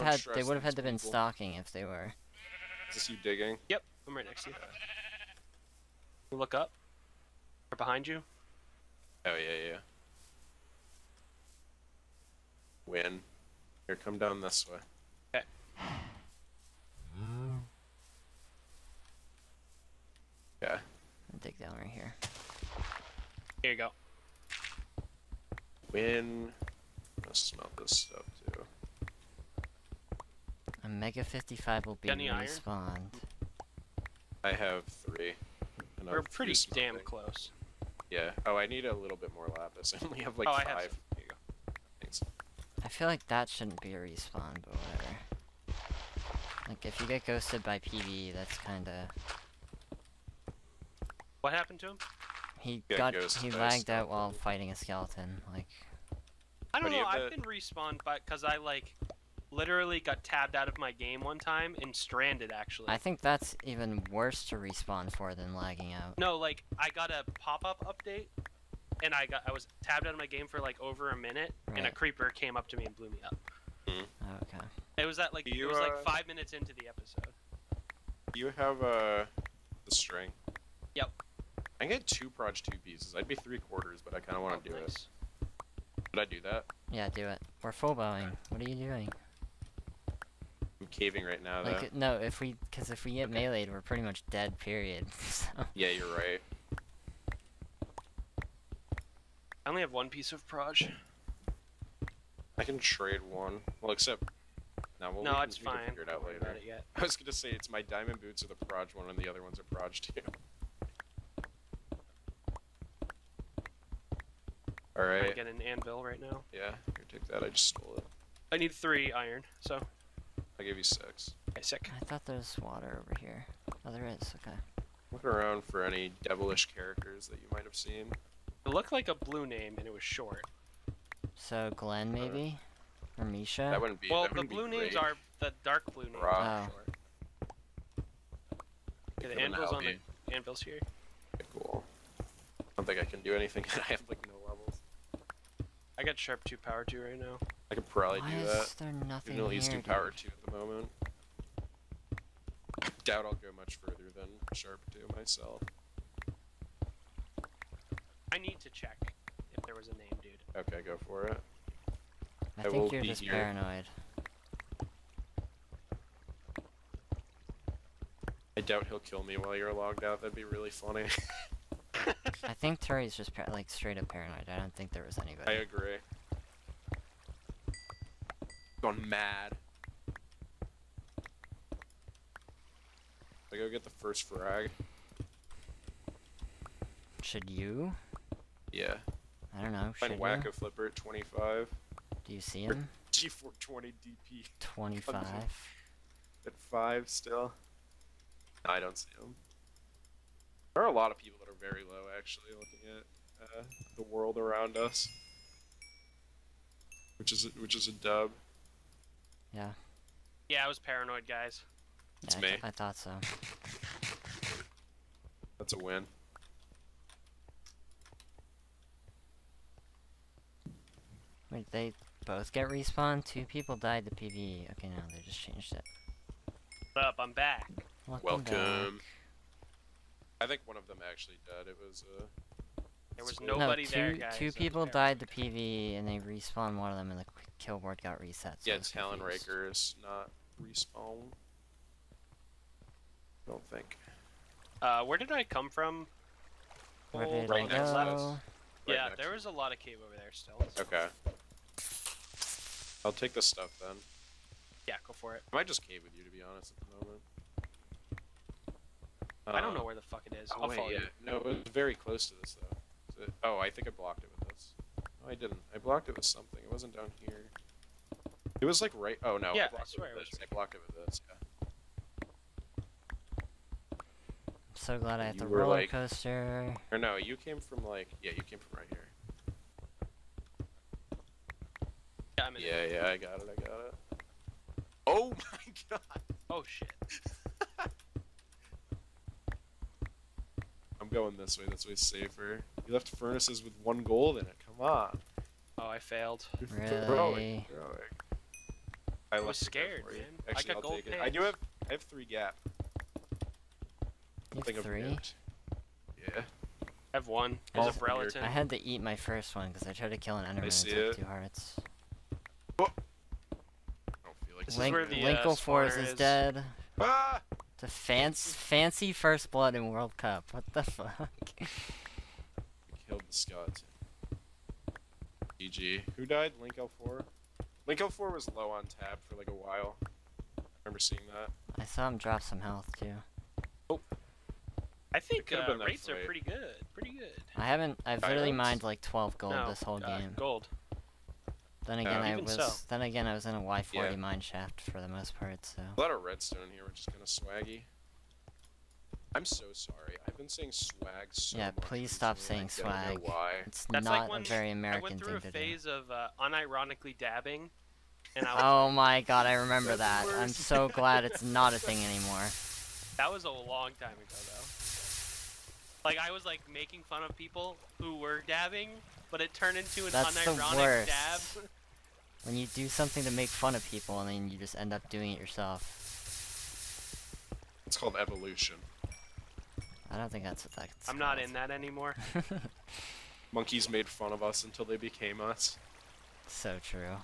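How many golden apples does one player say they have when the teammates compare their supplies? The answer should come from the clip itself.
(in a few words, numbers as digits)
3.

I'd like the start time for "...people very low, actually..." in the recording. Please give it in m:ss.
3:21.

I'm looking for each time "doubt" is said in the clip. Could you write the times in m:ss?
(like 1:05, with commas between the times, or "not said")
2:33, 2:48.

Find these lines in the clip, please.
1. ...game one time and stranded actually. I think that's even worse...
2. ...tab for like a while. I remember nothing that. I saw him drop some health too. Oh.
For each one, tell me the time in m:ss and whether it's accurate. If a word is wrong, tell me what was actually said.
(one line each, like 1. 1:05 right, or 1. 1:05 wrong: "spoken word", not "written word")
1. 1:00 right
2. 5:28 wrong: "seeing", not "nothing".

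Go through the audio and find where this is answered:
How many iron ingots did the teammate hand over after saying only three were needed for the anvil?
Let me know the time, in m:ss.
2:00.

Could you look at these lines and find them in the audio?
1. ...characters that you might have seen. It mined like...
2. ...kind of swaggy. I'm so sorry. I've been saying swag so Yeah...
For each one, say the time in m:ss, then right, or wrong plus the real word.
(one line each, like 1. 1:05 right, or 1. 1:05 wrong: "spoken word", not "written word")
1. 2:06 wrong: "looked", not "mined"
2. 5:47 right.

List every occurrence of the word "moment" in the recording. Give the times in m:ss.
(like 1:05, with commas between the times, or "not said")
2:30, 4:17.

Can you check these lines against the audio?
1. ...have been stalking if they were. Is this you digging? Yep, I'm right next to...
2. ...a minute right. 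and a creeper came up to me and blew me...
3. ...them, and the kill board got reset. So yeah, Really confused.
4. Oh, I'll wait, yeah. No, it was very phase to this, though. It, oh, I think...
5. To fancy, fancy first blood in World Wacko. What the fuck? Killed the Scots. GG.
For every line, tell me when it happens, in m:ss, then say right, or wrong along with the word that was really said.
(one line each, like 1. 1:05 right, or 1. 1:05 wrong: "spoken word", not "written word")
1. 0:00 right
2. 1:11 right
3. 3:56 wrong: "Talon", not "Really"
4. 4:20 wrong: "close", not "phase"
5. 5:17 wrong: "Cup", not "Wacko".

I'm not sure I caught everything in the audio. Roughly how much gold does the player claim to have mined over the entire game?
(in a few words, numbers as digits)
12.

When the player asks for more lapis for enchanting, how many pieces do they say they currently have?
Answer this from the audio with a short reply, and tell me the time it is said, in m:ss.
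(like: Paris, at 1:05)
5, at 0:40.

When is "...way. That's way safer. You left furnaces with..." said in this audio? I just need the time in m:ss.
4:51.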